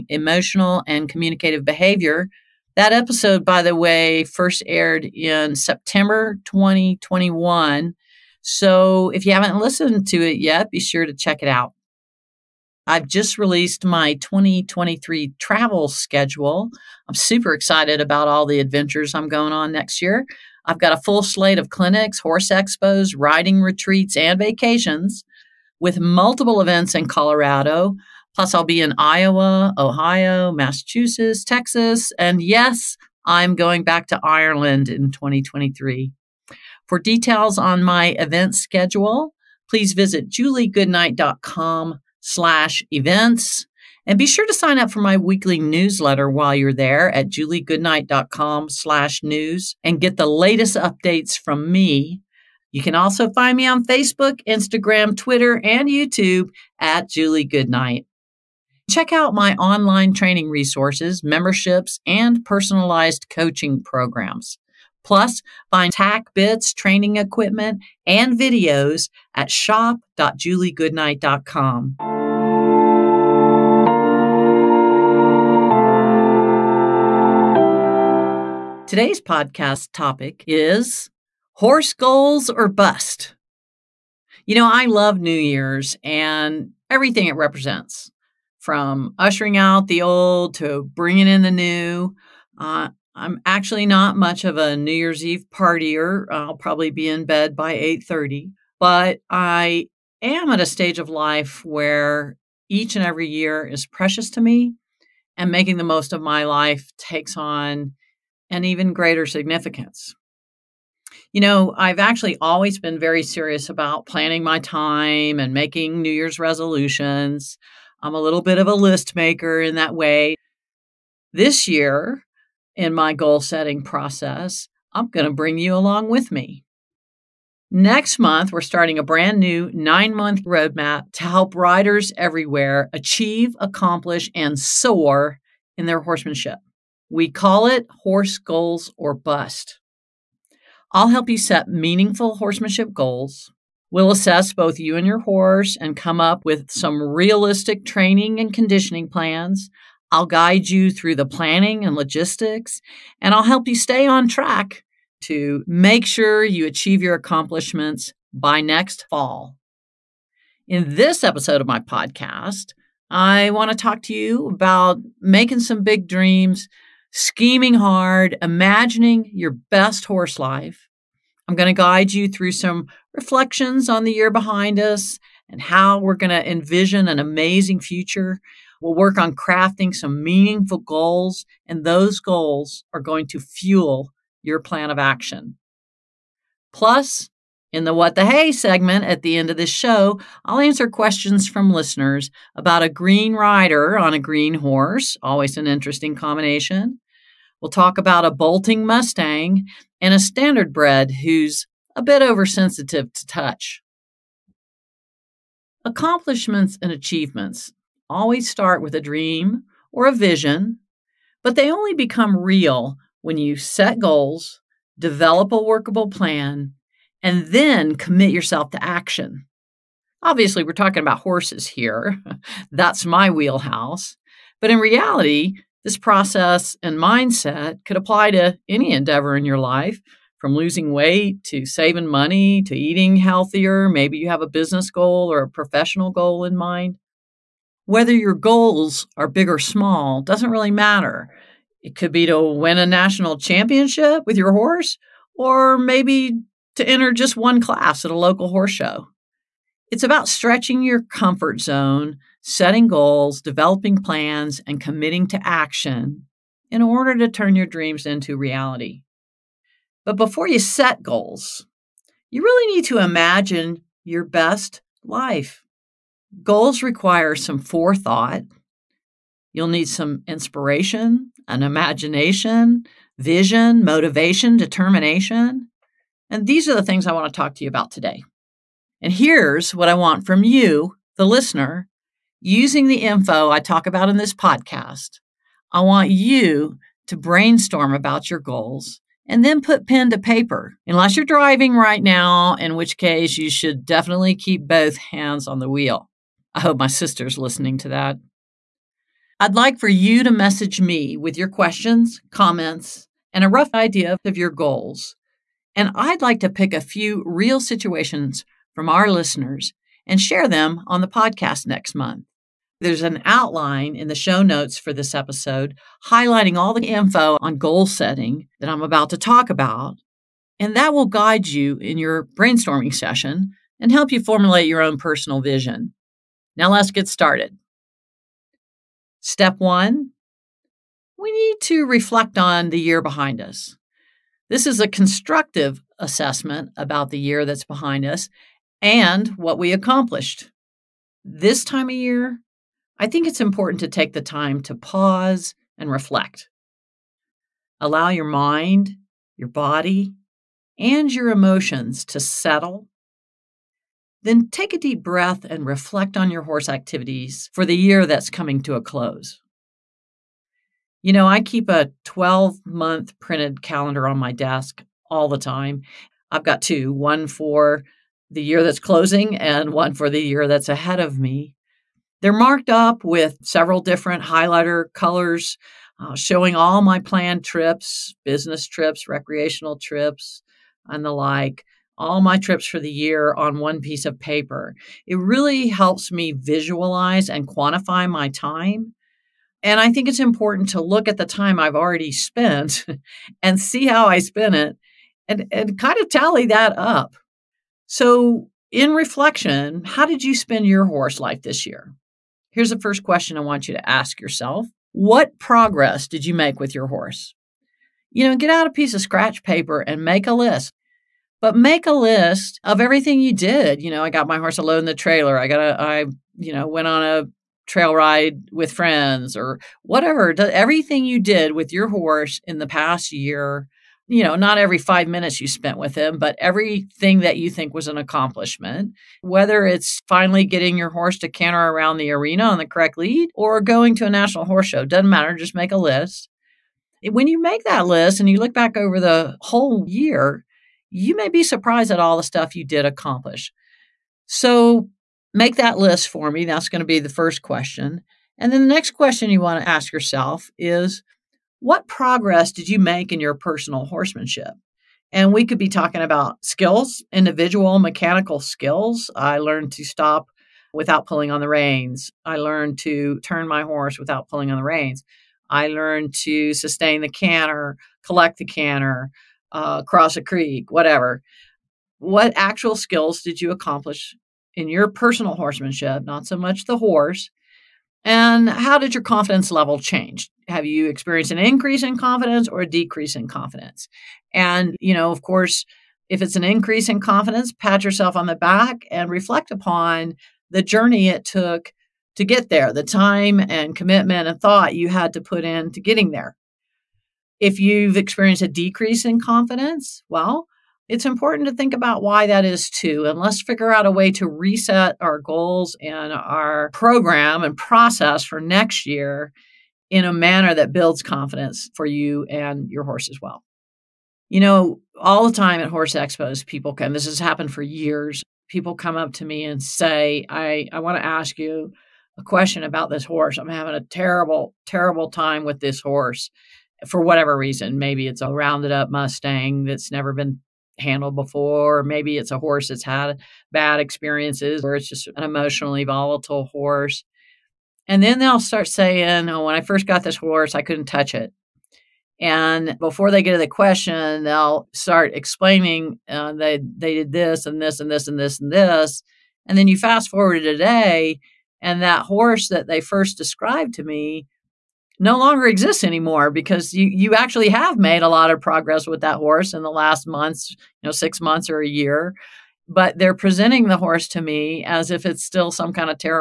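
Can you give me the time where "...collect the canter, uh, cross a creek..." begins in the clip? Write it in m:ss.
7:48.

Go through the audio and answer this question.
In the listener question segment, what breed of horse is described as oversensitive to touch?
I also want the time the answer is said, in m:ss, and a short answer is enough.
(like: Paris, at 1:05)
Standardbred, at 3:20.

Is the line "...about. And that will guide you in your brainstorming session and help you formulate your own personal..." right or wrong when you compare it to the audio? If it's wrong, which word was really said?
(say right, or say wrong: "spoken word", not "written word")
right.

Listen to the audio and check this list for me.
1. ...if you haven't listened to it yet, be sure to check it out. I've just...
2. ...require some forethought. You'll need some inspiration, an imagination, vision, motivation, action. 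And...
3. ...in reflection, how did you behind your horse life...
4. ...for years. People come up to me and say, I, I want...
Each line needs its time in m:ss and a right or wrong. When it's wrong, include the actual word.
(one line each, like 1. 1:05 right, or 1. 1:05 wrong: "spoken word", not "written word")
1. 0:09 right
2. 4:26 wrong: "determination", not "action"
3. 6:38 wrong: "spend", not "behind"
4. 8:37 right.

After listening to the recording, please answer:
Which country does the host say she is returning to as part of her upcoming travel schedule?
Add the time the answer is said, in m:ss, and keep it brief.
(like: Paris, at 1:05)
Ireland, at 0:34.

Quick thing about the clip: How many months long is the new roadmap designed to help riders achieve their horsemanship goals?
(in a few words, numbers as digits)
9.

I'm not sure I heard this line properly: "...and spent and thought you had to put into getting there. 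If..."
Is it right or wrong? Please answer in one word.
wrong.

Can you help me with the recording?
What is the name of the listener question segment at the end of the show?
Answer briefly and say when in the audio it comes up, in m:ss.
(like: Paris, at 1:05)
What the Hay, at 3:07.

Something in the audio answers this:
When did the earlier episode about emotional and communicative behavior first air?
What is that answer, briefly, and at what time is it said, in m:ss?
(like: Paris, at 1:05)
September 2021, at 0:05.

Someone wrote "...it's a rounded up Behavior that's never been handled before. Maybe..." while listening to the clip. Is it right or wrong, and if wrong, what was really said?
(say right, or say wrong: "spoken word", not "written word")
wrong: "Mustang", not "Behavior".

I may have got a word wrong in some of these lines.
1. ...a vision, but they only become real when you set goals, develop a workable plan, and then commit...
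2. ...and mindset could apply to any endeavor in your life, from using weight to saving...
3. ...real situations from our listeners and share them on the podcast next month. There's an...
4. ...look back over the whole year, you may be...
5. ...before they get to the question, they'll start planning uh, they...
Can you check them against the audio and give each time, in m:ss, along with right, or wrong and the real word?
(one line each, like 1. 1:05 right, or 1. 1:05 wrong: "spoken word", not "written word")
1. 3:30 right
2. 3:46 wrong: "losing", not "using"
3. 5:07 right
4. 7:18 right
5. 9:02 wrong: "explaining", not "planning".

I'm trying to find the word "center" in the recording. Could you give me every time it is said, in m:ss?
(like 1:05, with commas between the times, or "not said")
not said.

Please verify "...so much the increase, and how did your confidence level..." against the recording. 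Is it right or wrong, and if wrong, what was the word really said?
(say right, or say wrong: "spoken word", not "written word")
wrong: "horse", not "increase".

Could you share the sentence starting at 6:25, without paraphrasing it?
It really helps me visualize and quantify my time.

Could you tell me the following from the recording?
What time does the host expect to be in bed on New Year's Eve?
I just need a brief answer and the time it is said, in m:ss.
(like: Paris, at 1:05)
8:30, at 1:37.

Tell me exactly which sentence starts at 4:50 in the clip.
Unless you're driving right now, in which case you should definitely keep both hands on the wheel.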